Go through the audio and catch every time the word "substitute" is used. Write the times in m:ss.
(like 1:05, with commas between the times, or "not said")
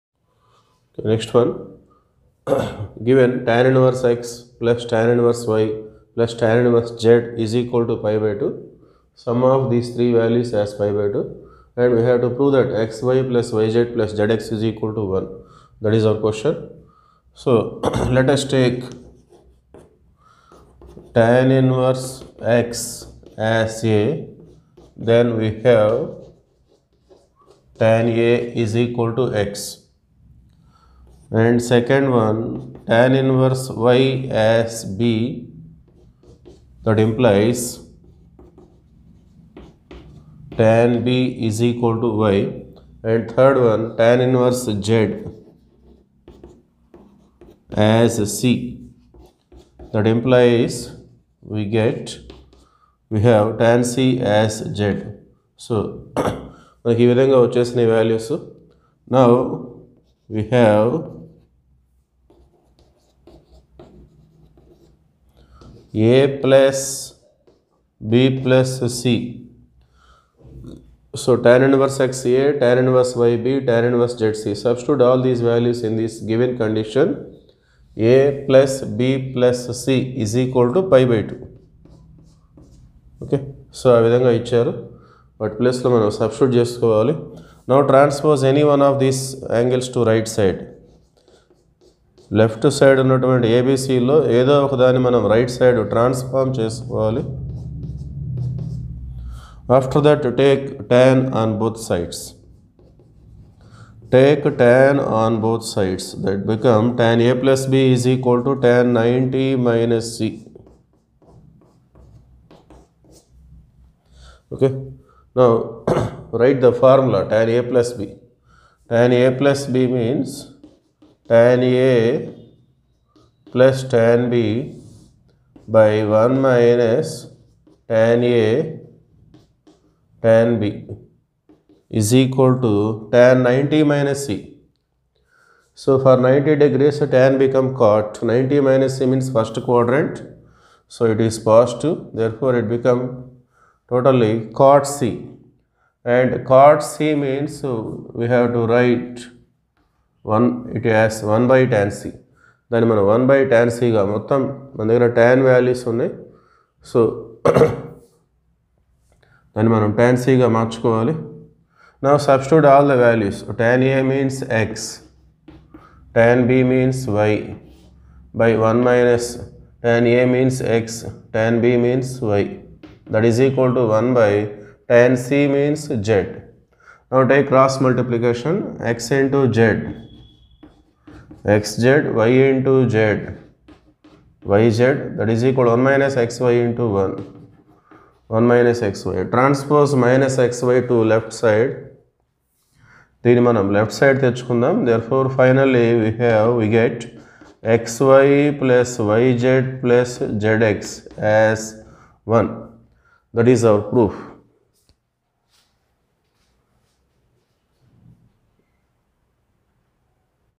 1:14, 1:26.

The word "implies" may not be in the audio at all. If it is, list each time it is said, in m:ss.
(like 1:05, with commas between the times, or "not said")
0:37, 0:50.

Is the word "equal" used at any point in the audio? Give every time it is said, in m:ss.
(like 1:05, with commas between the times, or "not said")
0:07, 0:14, 0:28, 0:41, 1:20, 2:12, 3:05.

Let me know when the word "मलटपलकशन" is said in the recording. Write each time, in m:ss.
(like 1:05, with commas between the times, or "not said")
2:57.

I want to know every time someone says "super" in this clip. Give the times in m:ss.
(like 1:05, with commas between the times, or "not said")
not said.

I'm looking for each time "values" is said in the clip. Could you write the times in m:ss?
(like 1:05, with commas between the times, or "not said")
0:10, 1:15.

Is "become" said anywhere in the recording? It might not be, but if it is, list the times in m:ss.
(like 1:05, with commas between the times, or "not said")
2:17, 2:22.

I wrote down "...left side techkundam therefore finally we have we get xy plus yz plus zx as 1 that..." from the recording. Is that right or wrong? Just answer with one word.
right.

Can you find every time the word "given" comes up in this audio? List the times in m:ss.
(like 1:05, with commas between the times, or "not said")
0:03, 1:16.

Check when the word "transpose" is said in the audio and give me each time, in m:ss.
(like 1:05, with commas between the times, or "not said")
1:27, 3:09.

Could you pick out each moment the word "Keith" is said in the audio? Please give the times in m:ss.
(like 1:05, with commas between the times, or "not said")
not said.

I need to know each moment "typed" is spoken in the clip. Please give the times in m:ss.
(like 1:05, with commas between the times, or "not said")
not said.